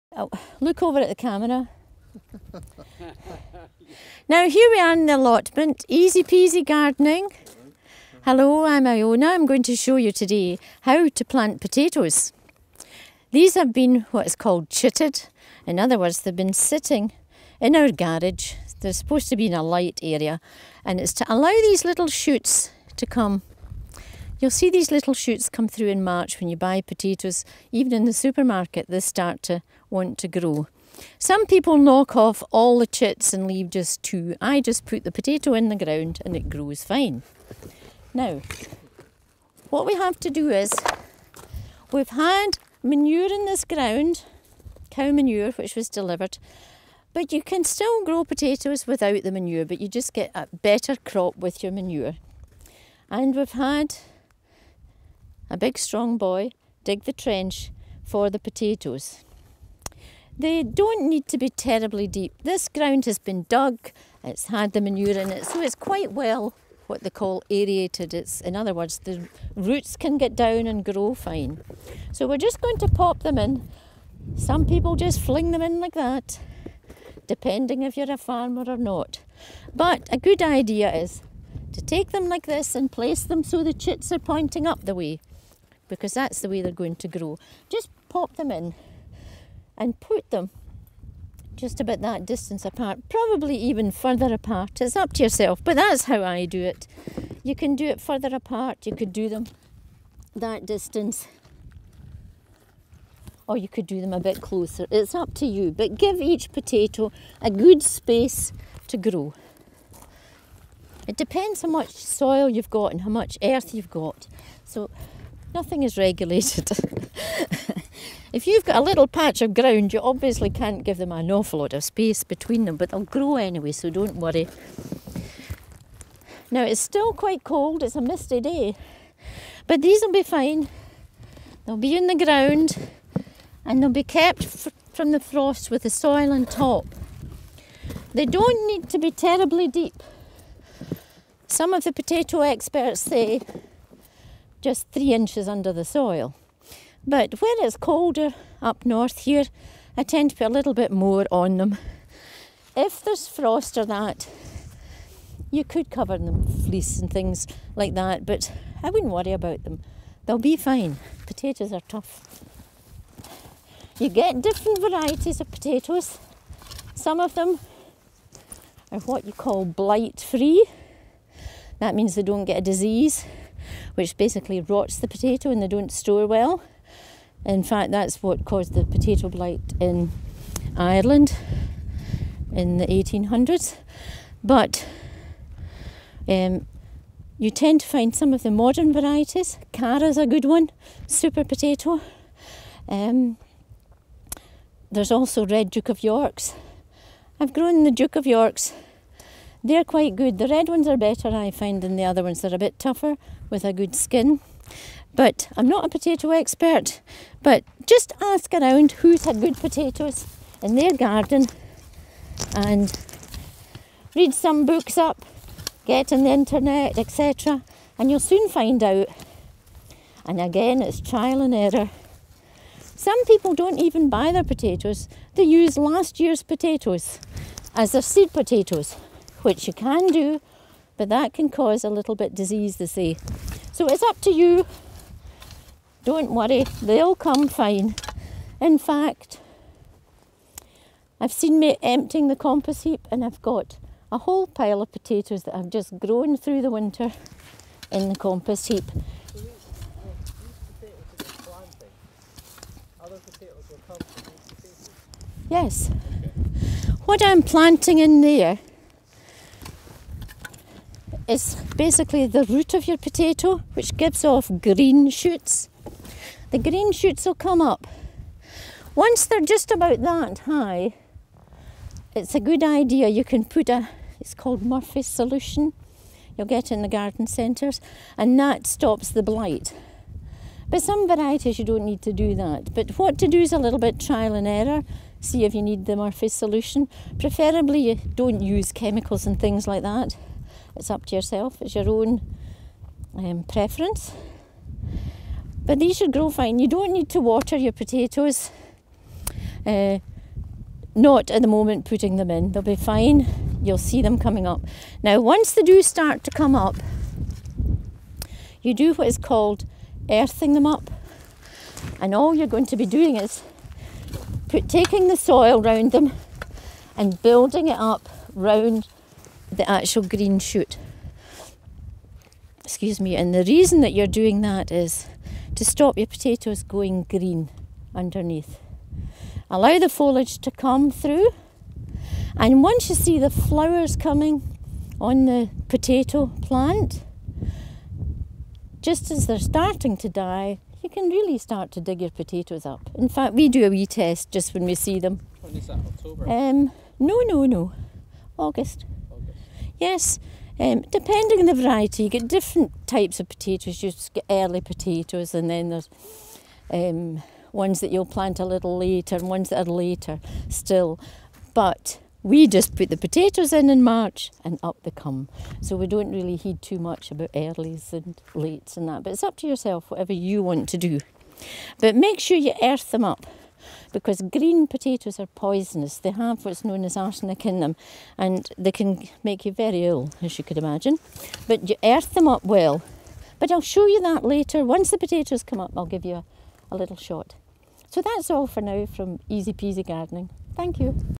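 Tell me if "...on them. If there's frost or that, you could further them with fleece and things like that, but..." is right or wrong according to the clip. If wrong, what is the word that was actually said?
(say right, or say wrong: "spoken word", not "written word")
wrong: "cover", not "further".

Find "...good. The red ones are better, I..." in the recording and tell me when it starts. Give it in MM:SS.
03:20.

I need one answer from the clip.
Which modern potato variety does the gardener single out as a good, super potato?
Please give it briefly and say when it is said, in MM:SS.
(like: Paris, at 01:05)
Cara, at 03:09.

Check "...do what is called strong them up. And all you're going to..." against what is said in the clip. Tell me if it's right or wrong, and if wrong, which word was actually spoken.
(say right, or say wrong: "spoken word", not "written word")
wrong: "earthing", not "strong".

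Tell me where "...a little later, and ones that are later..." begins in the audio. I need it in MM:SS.
05:58.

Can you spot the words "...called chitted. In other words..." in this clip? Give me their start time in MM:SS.
00:14.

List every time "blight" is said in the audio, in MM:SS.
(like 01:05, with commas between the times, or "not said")
02:49, 02:59, 04:39.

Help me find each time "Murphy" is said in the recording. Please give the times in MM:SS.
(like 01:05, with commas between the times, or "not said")
04:34, 04:45.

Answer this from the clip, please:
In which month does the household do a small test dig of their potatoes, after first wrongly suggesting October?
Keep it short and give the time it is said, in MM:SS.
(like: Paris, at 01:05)
August, at 05:48.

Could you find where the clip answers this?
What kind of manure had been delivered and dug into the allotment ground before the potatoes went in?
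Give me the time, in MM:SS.
00:44.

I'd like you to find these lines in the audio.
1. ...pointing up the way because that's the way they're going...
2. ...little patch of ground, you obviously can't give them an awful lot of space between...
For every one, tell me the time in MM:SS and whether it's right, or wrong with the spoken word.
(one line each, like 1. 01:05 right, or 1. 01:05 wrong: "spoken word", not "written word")
1. 01:24 right
2. 01:58 right.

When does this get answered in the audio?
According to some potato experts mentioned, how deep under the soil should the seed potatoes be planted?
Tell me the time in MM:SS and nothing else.
02:24.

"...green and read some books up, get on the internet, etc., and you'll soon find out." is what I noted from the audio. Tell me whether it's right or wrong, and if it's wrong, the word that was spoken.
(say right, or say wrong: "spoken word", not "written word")
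wrong: "garden", not "green".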